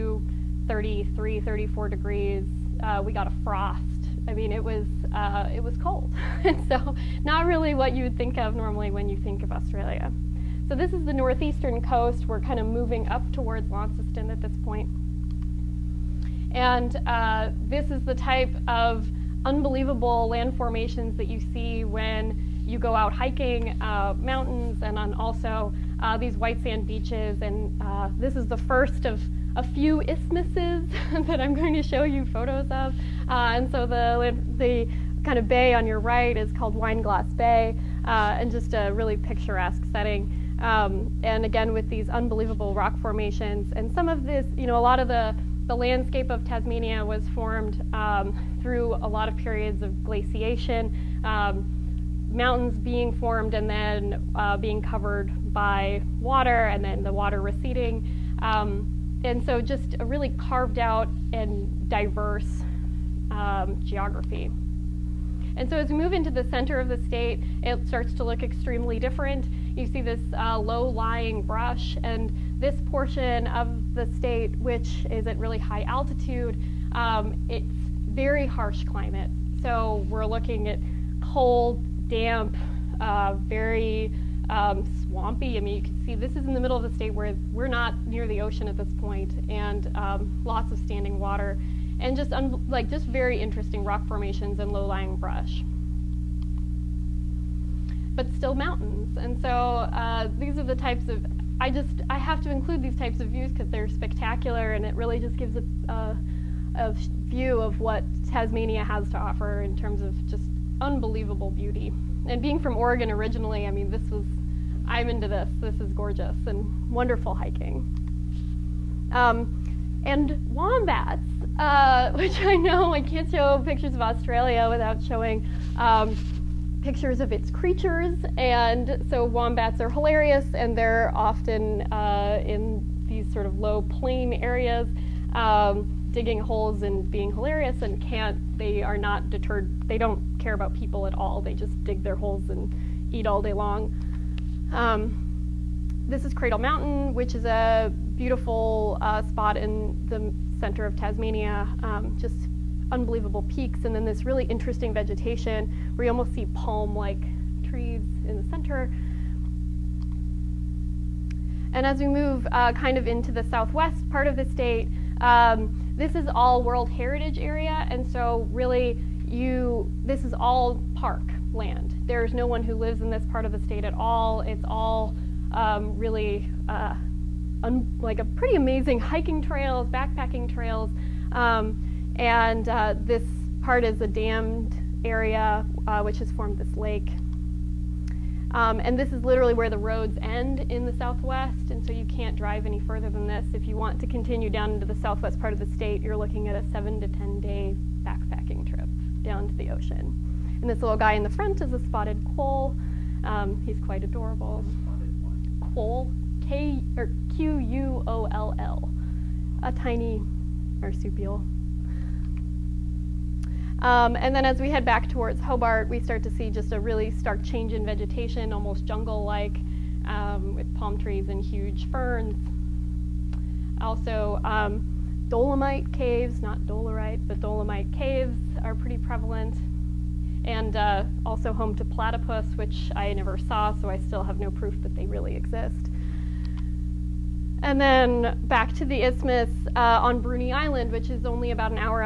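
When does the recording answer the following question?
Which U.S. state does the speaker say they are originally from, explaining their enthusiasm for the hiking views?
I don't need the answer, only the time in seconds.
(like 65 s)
112 s.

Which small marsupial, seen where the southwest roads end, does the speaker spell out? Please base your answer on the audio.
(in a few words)
spotted quoll.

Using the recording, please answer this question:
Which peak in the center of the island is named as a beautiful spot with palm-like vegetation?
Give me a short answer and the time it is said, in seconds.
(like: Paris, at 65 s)
Cradle Mountain, at 146 s.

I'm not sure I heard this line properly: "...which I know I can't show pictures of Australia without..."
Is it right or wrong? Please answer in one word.
right.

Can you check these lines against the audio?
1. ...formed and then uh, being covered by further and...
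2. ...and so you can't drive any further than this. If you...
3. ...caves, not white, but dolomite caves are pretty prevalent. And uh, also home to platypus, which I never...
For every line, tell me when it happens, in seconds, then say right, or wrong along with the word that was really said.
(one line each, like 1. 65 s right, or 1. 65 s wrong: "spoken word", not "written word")
1. 53 s wrong: "water", not "further"
2. 191 s right
3. 225 s wrong: "dolerite", not "white".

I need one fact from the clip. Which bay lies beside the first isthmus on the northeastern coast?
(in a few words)
Wineglass Bay.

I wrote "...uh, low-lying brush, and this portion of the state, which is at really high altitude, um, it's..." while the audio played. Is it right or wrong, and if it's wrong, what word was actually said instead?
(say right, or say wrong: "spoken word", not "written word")
right.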